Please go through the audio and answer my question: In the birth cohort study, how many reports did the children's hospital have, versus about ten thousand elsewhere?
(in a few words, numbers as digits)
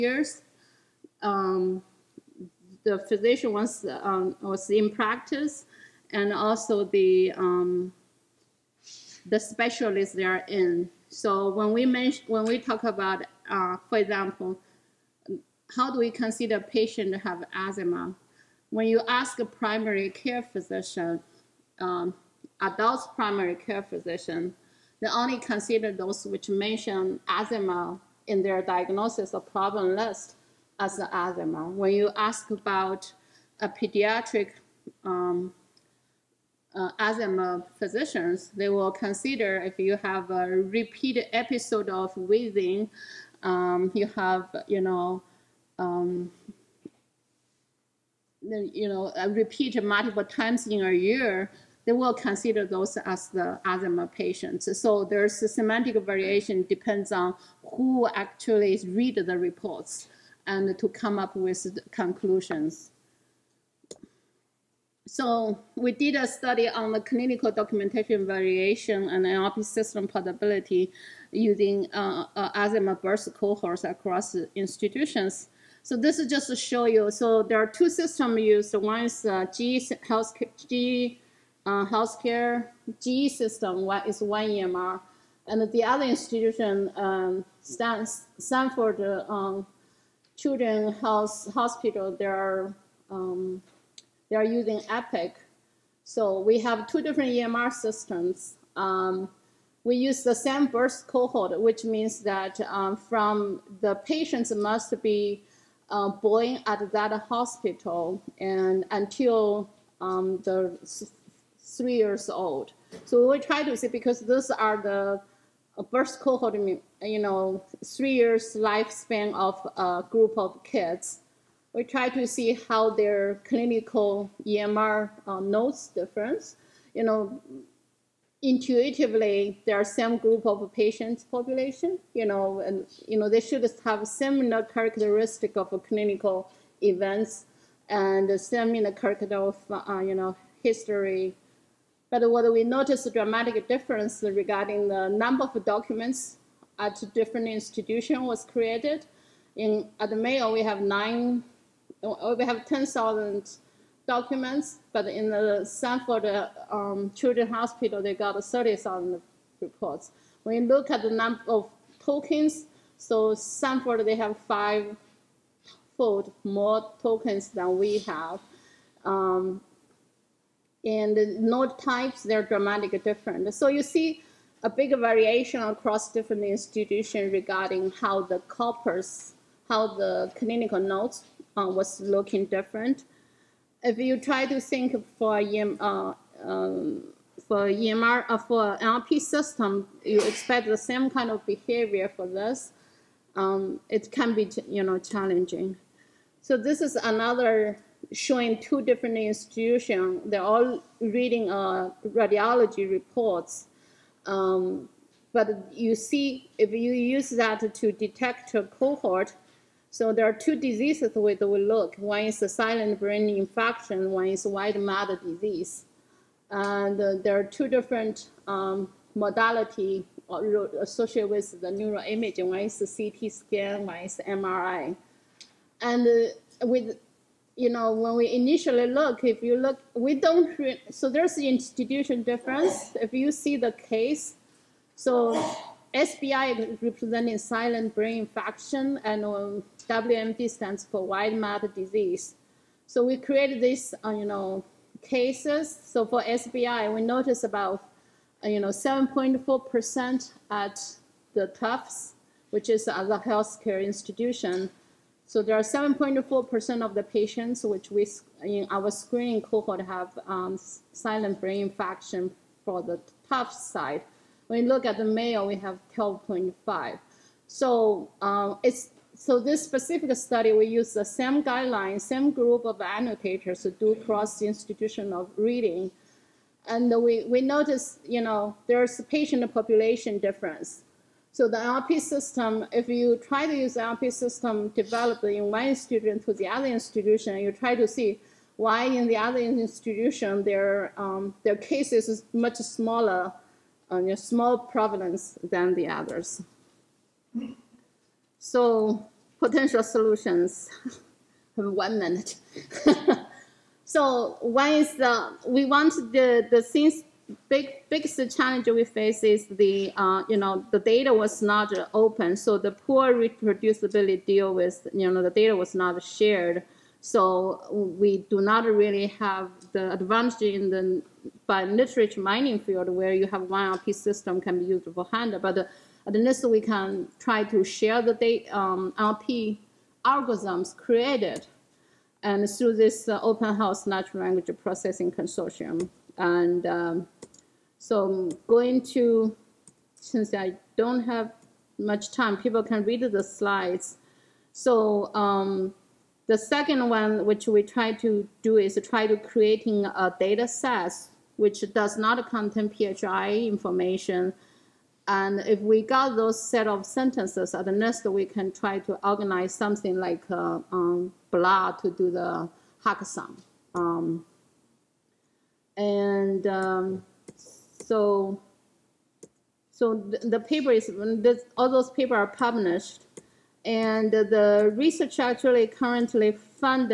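30,000.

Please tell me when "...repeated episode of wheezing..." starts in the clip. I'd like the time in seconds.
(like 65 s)
40 s.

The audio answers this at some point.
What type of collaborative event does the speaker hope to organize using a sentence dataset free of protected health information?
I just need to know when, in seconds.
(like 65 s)
362 s.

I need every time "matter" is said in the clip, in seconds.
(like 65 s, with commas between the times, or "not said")
214 s, 241 s.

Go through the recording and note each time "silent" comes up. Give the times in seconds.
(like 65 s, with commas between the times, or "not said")
212 s, 237 s, 260 s.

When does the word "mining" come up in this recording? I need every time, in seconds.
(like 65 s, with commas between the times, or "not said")
322 s.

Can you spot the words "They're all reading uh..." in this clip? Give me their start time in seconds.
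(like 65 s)
200 s.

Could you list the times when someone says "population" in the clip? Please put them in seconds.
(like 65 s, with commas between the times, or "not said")
131 s, 279 s.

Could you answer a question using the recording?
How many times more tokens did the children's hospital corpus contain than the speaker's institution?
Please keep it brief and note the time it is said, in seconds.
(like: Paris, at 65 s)
5, at 164 s.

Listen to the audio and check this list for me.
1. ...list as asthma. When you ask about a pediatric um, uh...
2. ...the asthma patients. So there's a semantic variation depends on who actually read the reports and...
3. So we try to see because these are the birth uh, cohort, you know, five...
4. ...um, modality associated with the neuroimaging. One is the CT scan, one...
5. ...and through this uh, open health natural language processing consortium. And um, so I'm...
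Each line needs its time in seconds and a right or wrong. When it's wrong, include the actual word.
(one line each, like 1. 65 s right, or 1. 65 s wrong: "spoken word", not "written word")
1. 29 s right
2. 53 s right
3. 113 s wrong: "three", not "five"
4. 218 s right
5. 332 s right.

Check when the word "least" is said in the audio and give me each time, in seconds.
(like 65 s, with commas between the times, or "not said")
326 s, 357 s.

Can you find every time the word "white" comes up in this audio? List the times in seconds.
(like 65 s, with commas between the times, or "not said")
214 s, 241 s.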